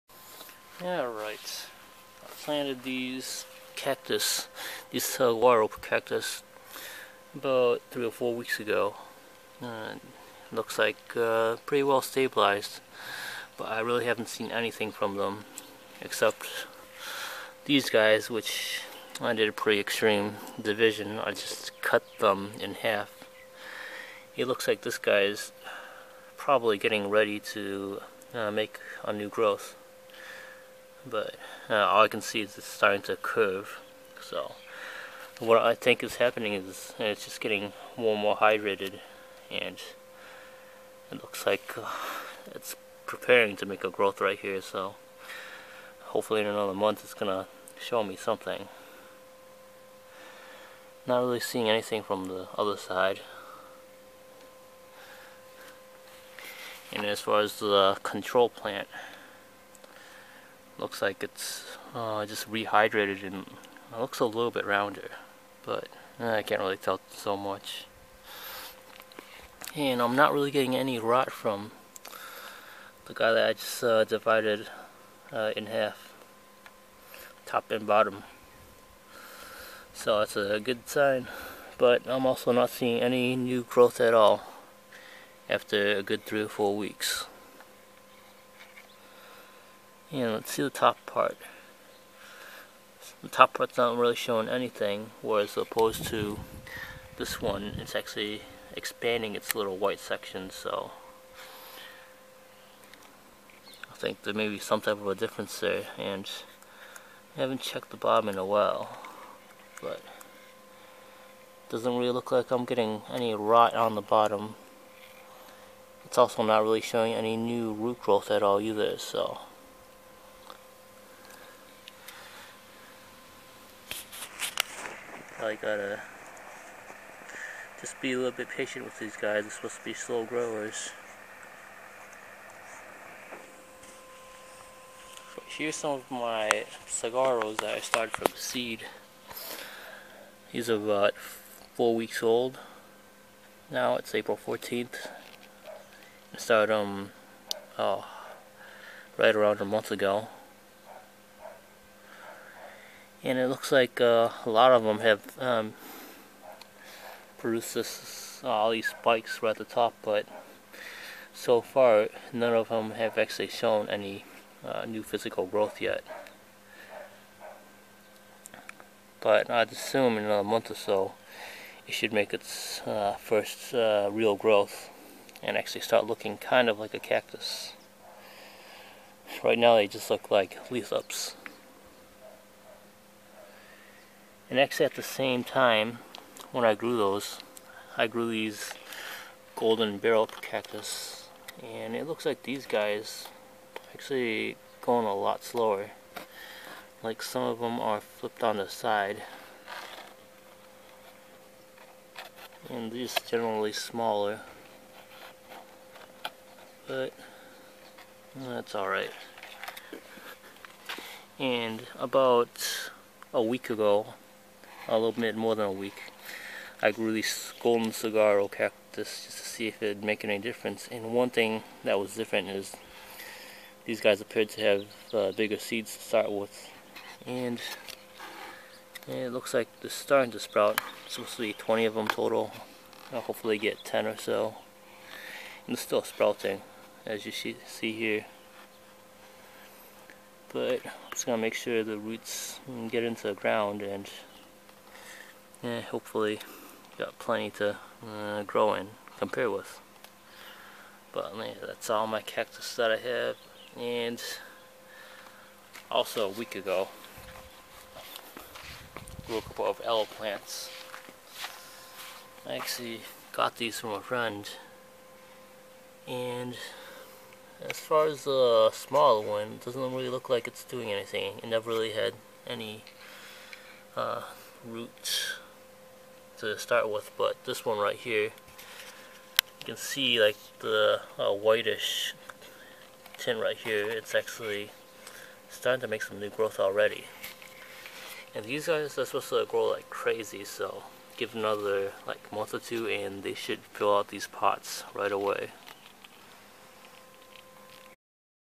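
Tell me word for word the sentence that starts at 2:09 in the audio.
They're supposed to be slow growers.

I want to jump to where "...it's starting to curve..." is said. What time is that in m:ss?
0:32.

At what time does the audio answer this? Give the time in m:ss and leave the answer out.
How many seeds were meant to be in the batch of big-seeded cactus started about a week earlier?
3:51.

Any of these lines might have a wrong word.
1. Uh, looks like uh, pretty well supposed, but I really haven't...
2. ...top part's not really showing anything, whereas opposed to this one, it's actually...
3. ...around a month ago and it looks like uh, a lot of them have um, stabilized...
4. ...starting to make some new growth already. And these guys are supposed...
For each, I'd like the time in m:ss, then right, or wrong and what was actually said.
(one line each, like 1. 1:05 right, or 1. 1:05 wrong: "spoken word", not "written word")
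1. 0:09 wrong: "stabilized", not "supposed"
2. 1:33 right
3. 2:29 wrong: "produced", not "stabilized"
4. 4:45 right.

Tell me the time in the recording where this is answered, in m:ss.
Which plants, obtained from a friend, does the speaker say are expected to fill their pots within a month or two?
4:19.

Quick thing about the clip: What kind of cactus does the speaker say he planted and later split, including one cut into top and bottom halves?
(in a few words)
Laurel cactus.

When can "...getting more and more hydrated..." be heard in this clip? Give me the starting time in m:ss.
0:37.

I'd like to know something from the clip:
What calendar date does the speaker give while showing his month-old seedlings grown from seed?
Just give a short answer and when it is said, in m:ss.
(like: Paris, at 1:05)
April 14th, at 2:24.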